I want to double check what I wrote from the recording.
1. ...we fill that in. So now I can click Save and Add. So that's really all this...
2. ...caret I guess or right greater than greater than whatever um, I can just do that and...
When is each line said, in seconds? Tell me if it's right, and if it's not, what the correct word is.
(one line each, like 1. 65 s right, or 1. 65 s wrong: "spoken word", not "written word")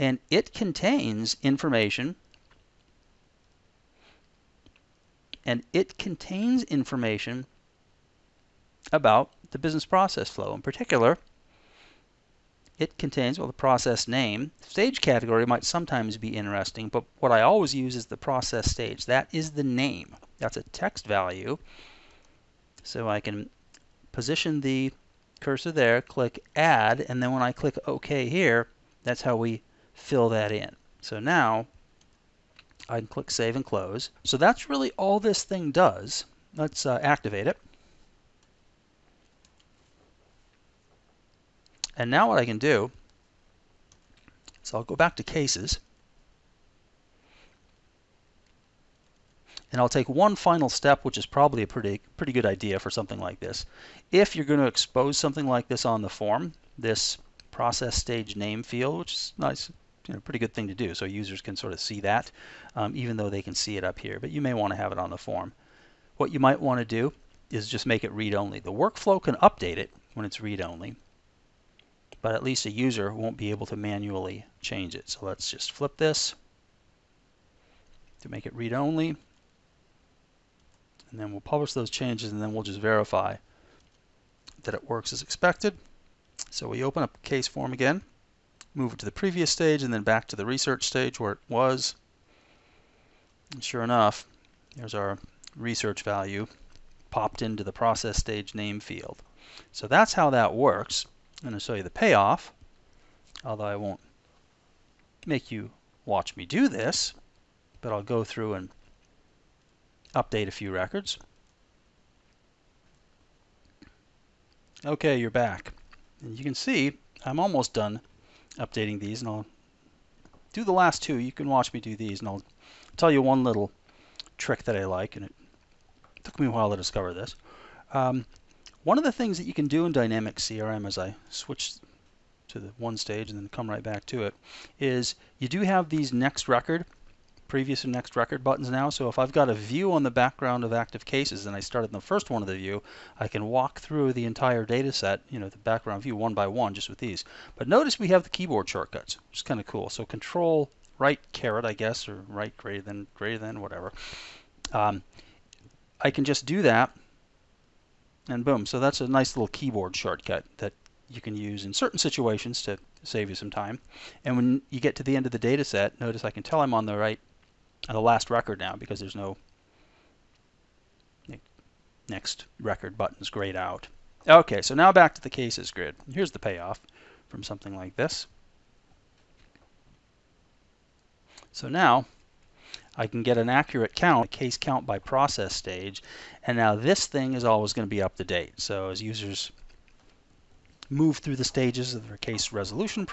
1. 29 s wrong: "Close", not "Add"
2. 151 s right.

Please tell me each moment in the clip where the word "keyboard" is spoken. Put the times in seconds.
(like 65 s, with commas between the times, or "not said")
148 s, 159 s.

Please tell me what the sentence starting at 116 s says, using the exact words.
And you can see I'm almost done updating these, and I'll do the last two.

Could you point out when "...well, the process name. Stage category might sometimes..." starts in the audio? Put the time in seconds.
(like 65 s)
13 s.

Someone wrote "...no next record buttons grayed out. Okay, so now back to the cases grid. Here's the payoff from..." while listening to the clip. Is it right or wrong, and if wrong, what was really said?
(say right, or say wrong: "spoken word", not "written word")
right.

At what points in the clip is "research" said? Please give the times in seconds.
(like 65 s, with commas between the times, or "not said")
90 s, 95 s.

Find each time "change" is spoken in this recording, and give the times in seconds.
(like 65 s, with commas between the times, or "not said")
74 s, 81 s.